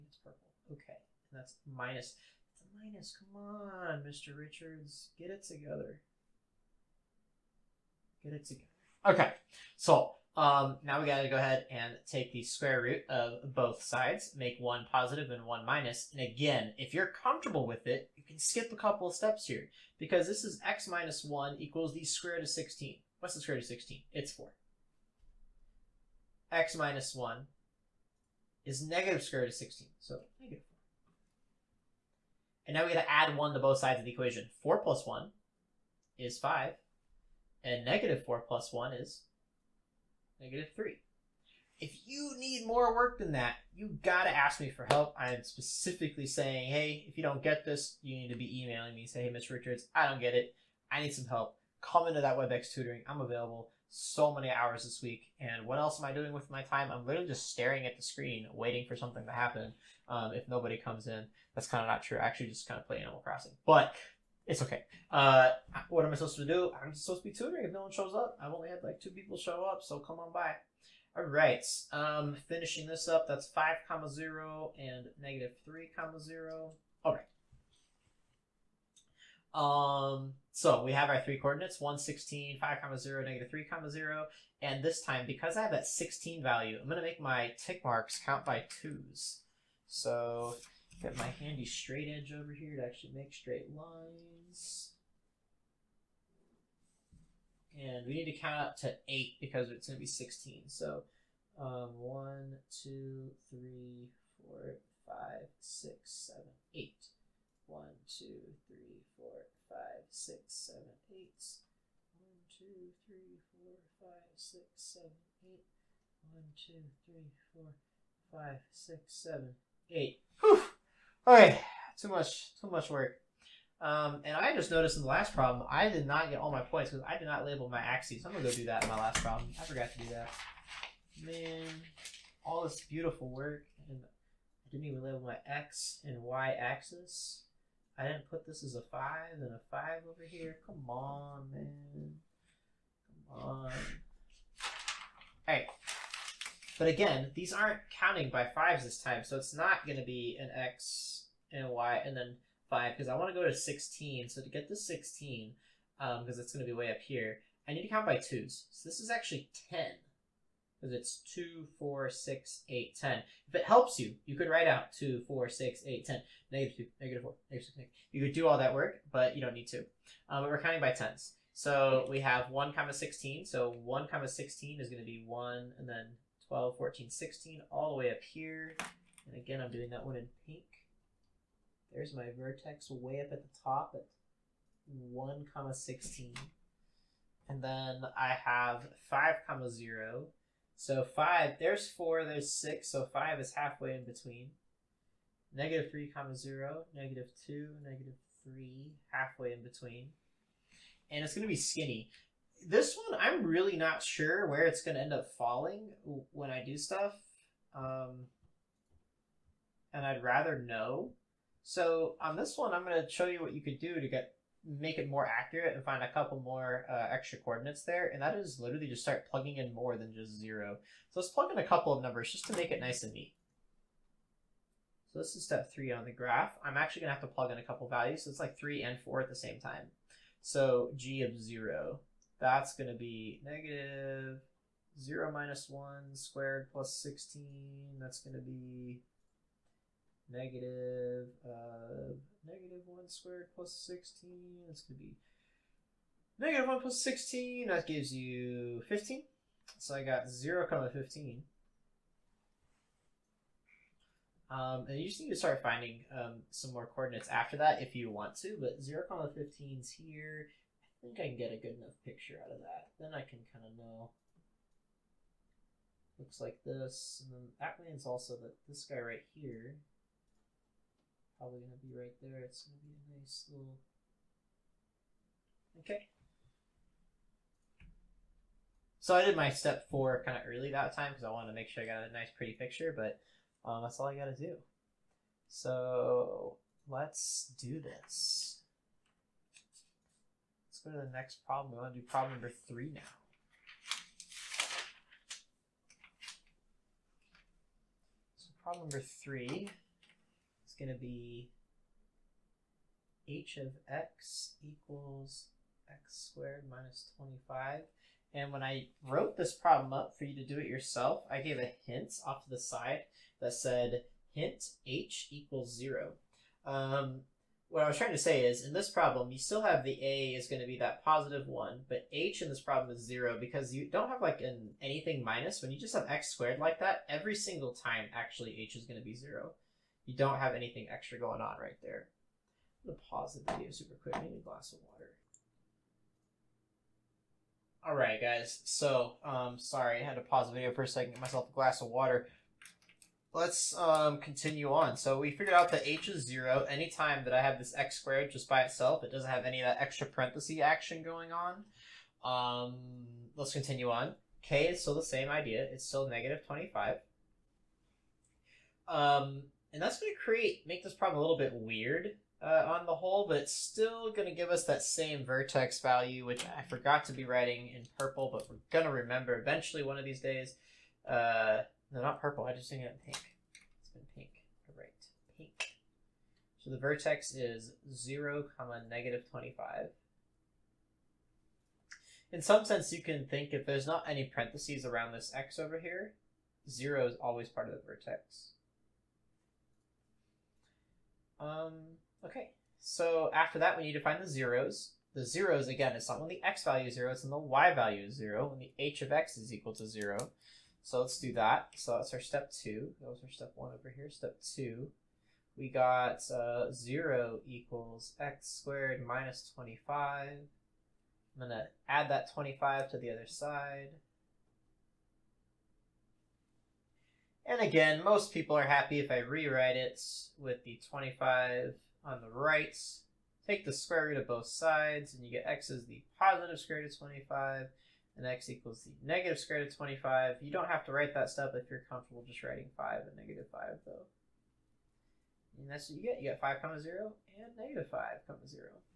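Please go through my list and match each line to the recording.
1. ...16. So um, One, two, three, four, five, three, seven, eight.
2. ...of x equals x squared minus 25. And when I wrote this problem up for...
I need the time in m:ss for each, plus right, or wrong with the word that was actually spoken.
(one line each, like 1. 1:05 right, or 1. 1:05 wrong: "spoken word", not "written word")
1. 1:40 wrong: "six", not "three"
2. 5:03 right.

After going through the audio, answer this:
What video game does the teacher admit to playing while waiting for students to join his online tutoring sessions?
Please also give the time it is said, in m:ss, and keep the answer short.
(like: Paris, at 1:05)
Animal Crossing, at 1:03.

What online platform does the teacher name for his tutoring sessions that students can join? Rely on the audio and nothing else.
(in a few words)
WebEx.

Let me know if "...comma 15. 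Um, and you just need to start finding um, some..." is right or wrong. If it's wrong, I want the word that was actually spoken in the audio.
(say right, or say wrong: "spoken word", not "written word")
right.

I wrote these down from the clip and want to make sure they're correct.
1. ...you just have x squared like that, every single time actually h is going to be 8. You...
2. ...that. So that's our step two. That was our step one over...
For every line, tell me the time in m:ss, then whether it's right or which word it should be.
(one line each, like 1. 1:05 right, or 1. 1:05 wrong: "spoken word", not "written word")
1. 5:25 wrong: "0", not "8"
2. 6:41 right.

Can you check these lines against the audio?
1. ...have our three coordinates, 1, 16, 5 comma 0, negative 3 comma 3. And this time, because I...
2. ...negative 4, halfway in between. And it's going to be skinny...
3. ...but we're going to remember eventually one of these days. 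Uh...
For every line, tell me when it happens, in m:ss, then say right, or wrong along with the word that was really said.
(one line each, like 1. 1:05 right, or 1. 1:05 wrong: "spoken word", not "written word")
1. 1:20 wrong: "0", not "3"
2. 3:17 wrong: "3", not "4"
3. 6:08 right.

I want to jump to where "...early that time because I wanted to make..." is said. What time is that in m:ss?
4:40.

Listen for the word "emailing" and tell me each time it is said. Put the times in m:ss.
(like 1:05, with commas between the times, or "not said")
0:48.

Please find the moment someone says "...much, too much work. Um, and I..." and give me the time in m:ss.
2:02.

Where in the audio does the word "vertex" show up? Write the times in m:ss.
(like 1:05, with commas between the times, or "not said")
3:02, 6:05, 6:16, 6:27.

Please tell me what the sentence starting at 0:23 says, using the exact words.
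What's the square root of 16?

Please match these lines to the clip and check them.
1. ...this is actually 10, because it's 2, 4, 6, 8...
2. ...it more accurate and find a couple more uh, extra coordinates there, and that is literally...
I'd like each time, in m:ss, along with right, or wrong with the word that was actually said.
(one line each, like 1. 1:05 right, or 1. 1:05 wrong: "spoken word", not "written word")
1. 2:38 right
2. 3:34 right.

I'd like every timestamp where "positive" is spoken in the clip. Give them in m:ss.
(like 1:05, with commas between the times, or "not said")
0:14, 5:21, 7:06.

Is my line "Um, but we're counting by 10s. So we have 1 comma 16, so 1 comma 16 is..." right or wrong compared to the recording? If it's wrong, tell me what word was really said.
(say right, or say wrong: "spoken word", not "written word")
right.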